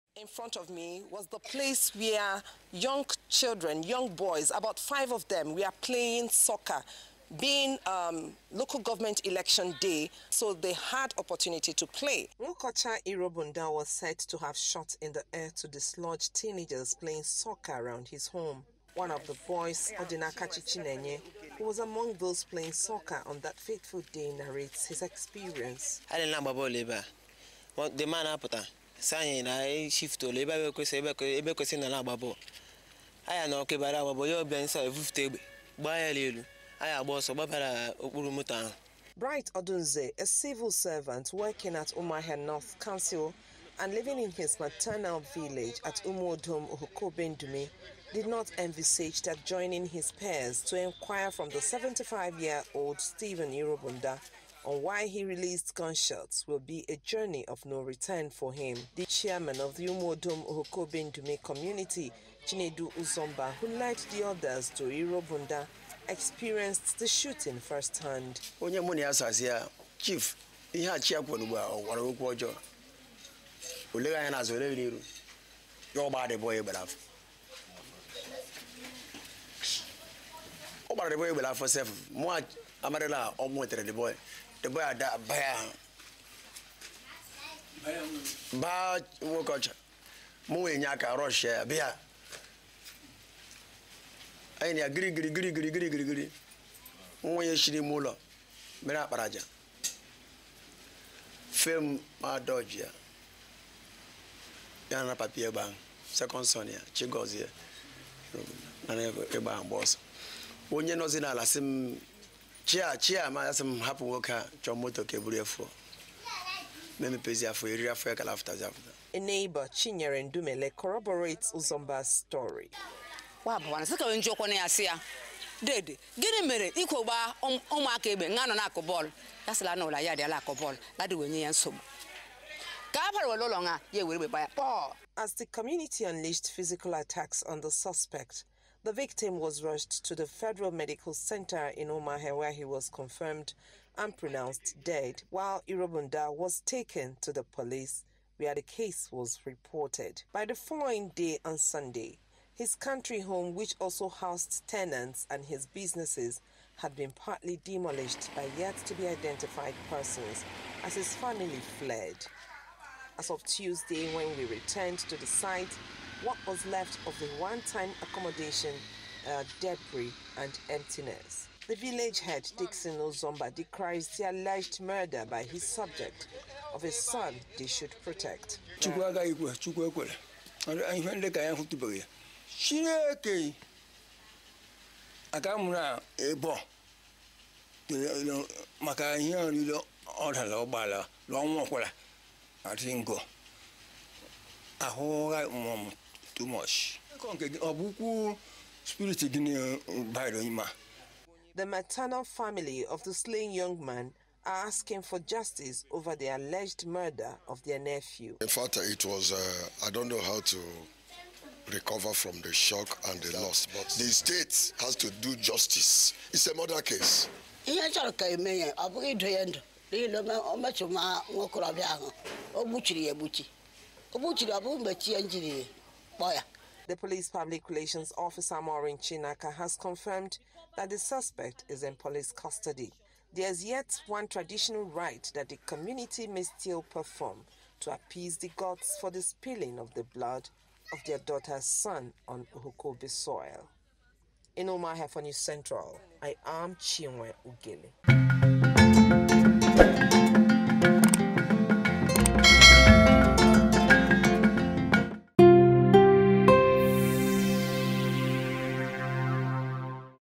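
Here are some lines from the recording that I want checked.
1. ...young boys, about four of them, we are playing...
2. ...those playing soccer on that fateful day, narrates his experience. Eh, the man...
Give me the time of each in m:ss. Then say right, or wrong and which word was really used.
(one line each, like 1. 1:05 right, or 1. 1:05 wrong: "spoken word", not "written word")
1. 0:03 wrong: "five", not "four"
2. 0:22 right.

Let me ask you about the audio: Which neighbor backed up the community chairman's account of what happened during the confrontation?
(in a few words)
Chinyere Ndumele.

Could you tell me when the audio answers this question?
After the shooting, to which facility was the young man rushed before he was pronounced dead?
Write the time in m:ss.
2:20.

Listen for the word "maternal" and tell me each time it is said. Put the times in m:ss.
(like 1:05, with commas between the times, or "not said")
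0:44, 3:21.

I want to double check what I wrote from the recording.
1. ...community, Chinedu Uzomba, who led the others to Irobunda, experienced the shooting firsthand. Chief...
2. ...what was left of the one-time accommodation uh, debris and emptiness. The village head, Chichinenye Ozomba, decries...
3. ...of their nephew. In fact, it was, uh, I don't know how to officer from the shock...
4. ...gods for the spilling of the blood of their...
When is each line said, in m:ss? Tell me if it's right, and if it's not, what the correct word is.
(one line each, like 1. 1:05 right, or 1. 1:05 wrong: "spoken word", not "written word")
1. 1:01 right
2. 2:46 wrong: "Dixon", not "Chichinenye"
3. 3:27 wrong: "recover", not "officer"
4. 3:58 right.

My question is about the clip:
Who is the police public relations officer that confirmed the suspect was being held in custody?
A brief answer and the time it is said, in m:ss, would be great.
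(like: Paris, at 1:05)
Maureen Chinaka, at 3:48.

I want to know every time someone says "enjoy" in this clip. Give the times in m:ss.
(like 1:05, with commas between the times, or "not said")
not said.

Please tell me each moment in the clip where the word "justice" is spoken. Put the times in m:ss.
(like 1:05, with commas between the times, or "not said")
3:25, 3:35.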